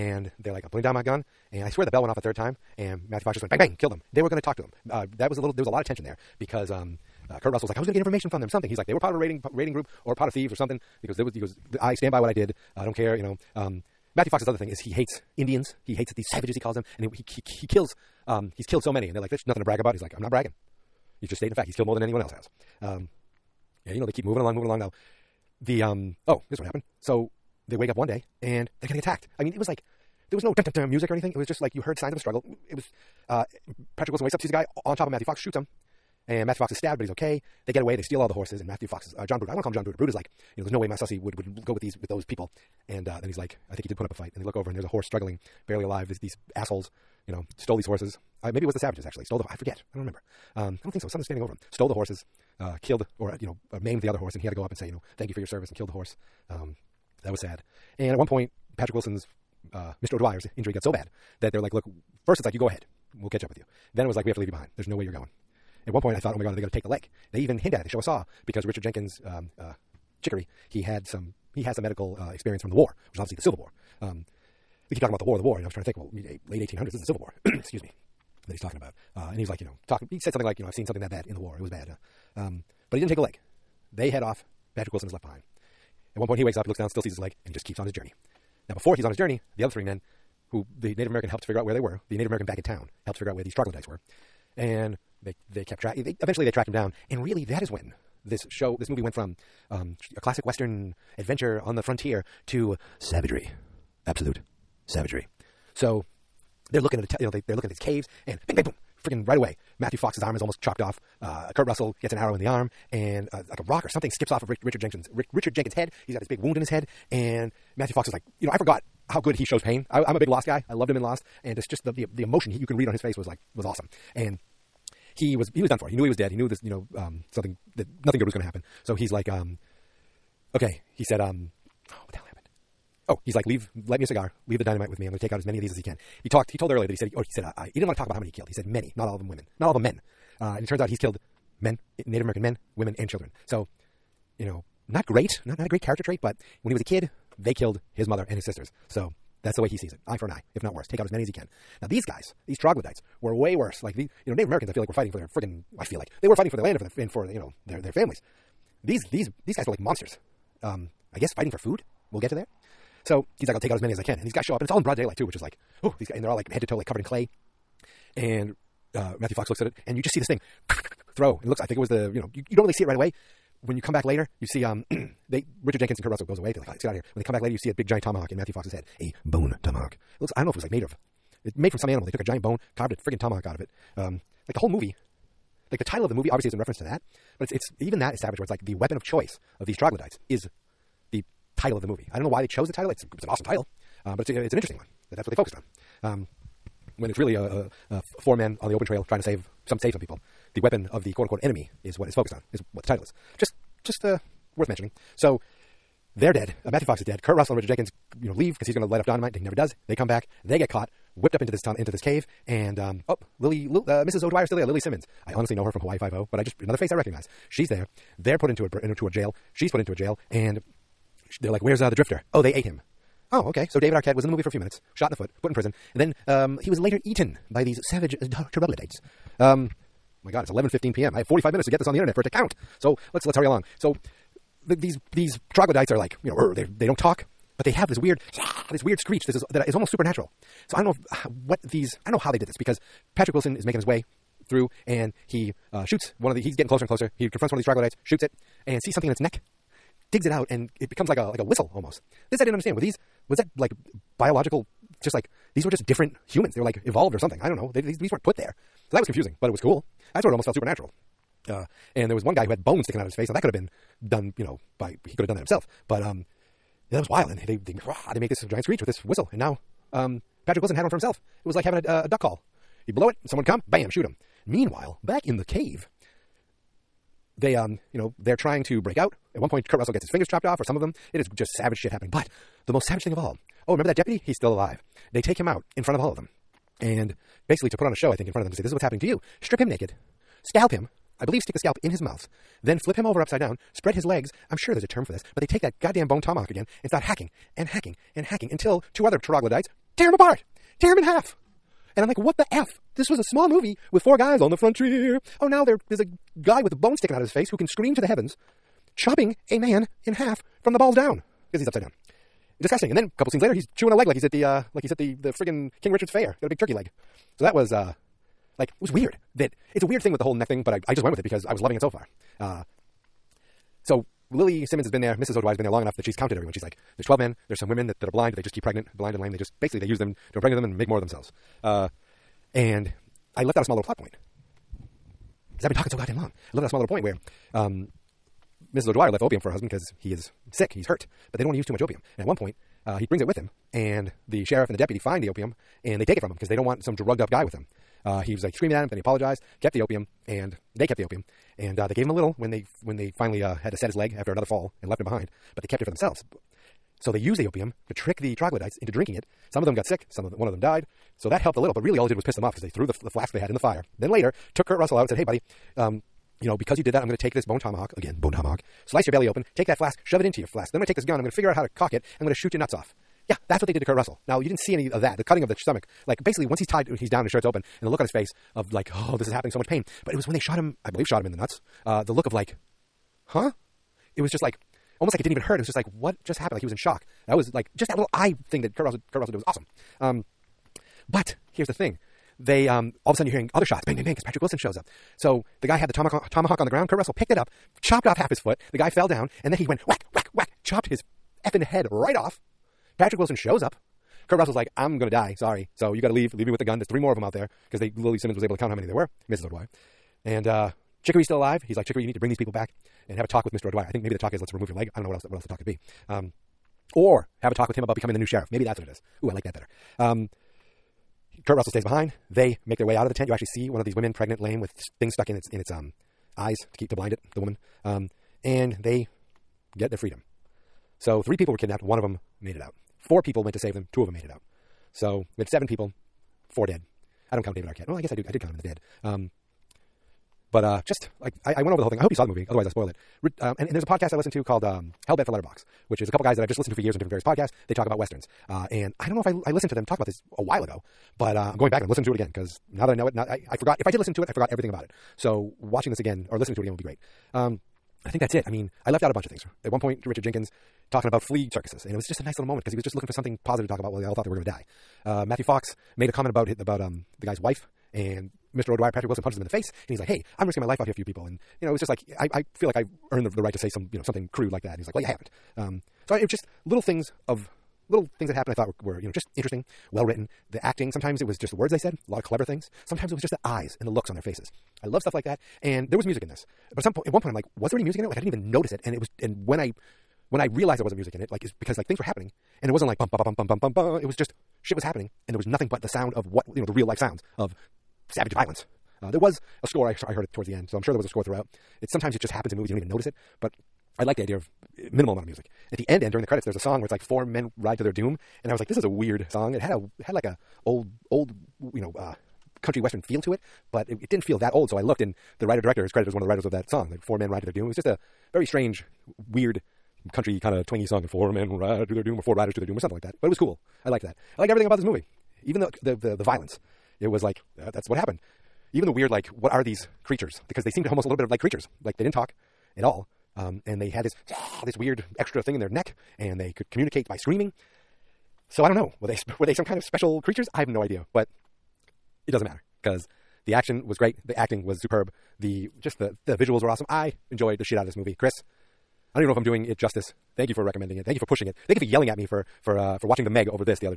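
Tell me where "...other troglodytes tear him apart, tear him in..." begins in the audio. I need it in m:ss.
4:59.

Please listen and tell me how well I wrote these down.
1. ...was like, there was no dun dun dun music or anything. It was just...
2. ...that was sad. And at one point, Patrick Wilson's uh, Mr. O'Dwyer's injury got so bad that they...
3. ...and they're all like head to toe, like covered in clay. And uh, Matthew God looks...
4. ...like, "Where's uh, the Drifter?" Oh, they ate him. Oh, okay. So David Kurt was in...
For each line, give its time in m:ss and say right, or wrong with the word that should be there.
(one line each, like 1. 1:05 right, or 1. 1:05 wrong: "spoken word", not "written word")
1. 0:29 right
2. 0:57 right
3. 2:46 wrong: "Fox", not "God"
4. 3:41 wrong: "Arquette", not "Kurt".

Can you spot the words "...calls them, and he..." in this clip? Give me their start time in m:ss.
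0:16.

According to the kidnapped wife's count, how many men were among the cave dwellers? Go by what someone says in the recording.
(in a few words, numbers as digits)
12.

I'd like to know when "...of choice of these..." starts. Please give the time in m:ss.
3:08.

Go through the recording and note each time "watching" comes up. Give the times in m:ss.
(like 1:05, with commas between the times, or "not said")
7:35, 9:13.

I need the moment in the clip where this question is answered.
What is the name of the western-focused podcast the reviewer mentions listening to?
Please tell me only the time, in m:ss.
7:25.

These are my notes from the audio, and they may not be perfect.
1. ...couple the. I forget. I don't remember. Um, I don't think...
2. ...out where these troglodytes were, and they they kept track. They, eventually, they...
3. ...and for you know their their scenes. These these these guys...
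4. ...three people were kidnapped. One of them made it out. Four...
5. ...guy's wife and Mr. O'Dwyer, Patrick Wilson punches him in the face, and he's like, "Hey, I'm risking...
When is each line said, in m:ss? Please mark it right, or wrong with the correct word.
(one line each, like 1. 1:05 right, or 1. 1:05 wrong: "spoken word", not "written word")
1. 0:49 wrong: "stole", not "couple"
2. 1:33 right
3. 2:37 wrong: "families", not "scenes"
4. 7:11 right
5. 7:47 right.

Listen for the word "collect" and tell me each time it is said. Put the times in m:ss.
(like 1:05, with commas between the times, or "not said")
not said.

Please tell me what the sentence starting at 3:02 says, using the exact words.
They took a giant bone, carved a friggin' tomahawk out of it.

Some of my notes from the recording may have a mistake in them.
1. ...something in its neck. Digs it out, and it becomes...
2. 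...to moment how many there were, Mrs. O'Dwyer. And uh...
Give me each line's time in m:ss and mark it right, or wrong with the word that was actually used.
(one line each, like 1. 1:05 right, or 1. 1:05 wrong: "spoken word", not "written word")
1. 4:08 right
2. 6:48 wrong: "count", not "moment".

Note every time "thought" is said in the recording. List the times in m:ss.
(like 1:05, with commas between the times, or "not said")
1:06, 7:44, 7:58.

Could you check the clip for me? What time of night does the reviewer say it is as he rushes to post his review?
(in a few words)
11:15 p.m.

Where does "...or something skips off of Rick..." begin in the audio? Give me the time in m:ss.
1:53.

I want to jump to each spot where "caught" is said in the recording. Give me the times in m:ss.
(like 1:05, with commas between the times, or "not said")
3:30.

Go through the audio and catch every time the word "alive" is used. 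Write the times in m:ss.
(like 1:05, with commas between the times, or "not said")
0:45, 4:44, 6:51.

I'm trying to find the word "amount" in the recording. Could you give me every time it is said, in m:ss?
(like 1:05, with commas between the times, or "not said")
8:25.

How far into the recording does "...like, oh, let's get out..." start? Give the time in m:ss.
2:56.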